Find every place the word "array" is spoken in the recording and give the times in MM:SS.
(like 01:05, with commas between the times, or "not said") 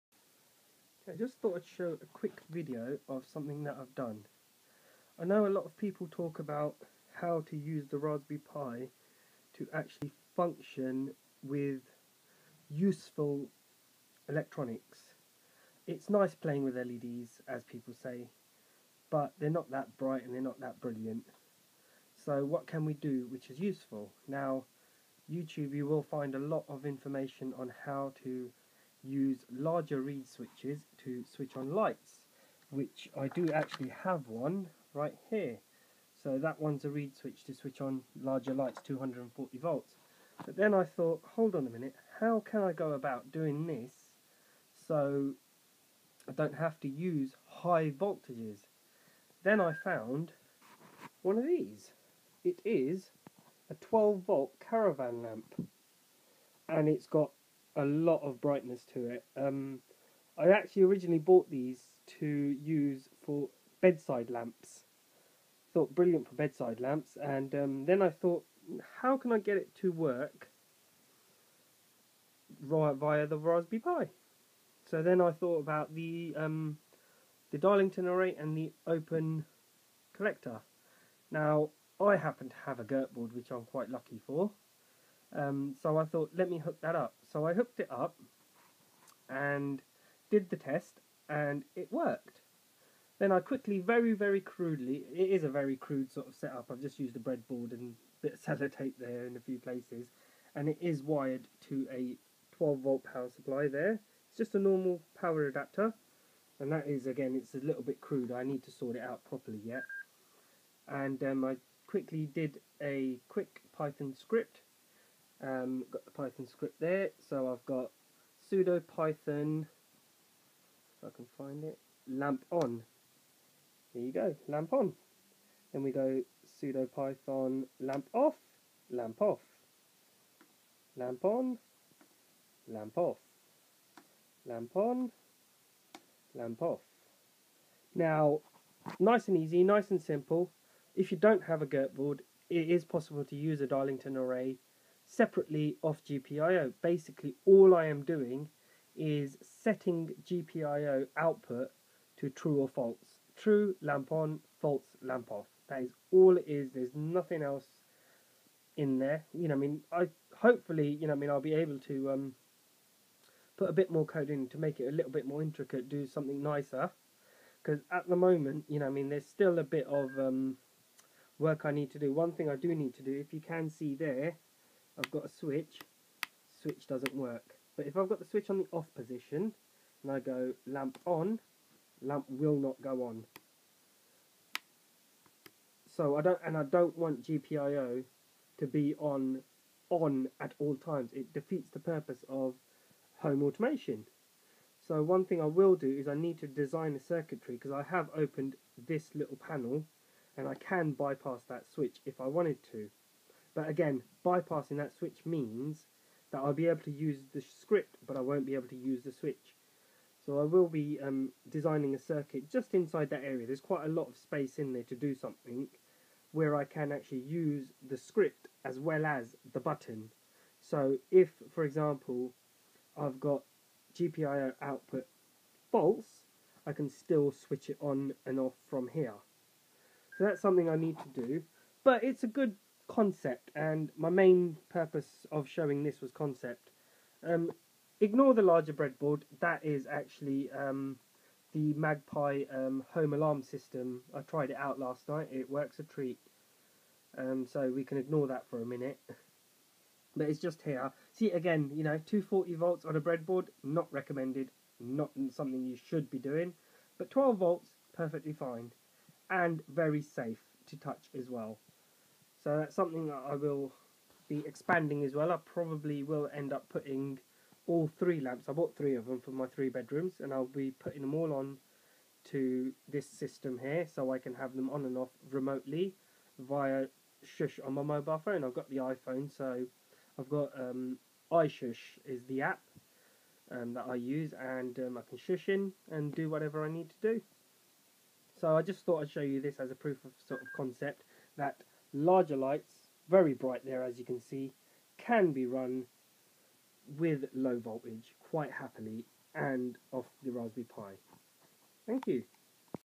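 01:18, 02:24.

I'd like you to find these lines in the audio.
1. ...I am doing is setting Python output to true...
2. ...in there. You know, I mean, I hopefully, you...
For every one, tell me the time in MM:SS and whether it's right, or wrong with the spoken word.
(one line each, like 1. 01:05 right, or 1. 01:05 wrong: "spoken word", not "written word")
1. 02:27 wrong: "GPIO", not "Python"
2. 02:38 right.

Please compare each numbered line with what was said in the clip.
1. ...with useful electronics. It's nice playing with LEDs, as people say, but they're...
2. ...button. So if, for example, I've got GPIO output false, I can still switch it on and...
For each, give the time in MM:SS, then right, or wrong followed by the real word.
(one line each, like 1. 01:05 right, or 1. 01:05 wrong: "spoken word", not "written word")
1. 00:11 right
2. 03:39 right.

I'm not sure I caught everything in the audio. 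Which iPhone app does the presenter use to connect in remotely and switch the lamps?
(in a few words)
iShush.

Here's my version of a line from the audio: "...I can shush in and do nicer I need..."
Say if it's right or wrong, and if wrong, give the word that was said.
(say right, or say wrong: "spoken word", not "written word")
wrong: "whatever", not "nicer".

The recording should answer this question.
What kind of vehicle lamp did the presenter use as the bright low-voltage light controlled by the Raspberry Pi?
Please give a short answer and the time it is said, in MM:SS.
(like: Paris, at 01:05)
Caravan lamp, at 00:54.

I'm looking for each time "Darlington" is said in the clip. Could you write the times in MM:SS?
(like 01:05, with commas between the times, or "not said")
01:17, 02:23.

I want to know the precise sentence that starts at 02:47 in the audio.
Because at the moment, you know, I mean, there's still a bit of um, work I need to do.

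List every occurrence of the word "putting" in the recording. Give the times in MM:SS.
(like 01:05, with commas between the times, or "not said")
04:26, 04:30.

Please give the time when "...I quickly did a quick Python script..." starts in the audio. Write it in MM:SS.
01:51.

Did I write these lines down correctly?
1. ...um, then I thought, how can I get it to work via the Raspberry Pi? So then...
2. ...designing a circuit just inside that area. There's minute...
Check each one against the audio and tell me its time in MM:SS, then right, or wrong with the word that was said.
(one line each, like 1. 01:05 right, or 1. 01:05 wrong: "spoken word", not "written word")
1. 01:07 right
2. 03:31 wrong: "quite", not "minute".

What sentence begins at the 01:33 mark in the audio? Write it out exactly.
Then I quickly, very, very crudely, it is a very crude sort of setup.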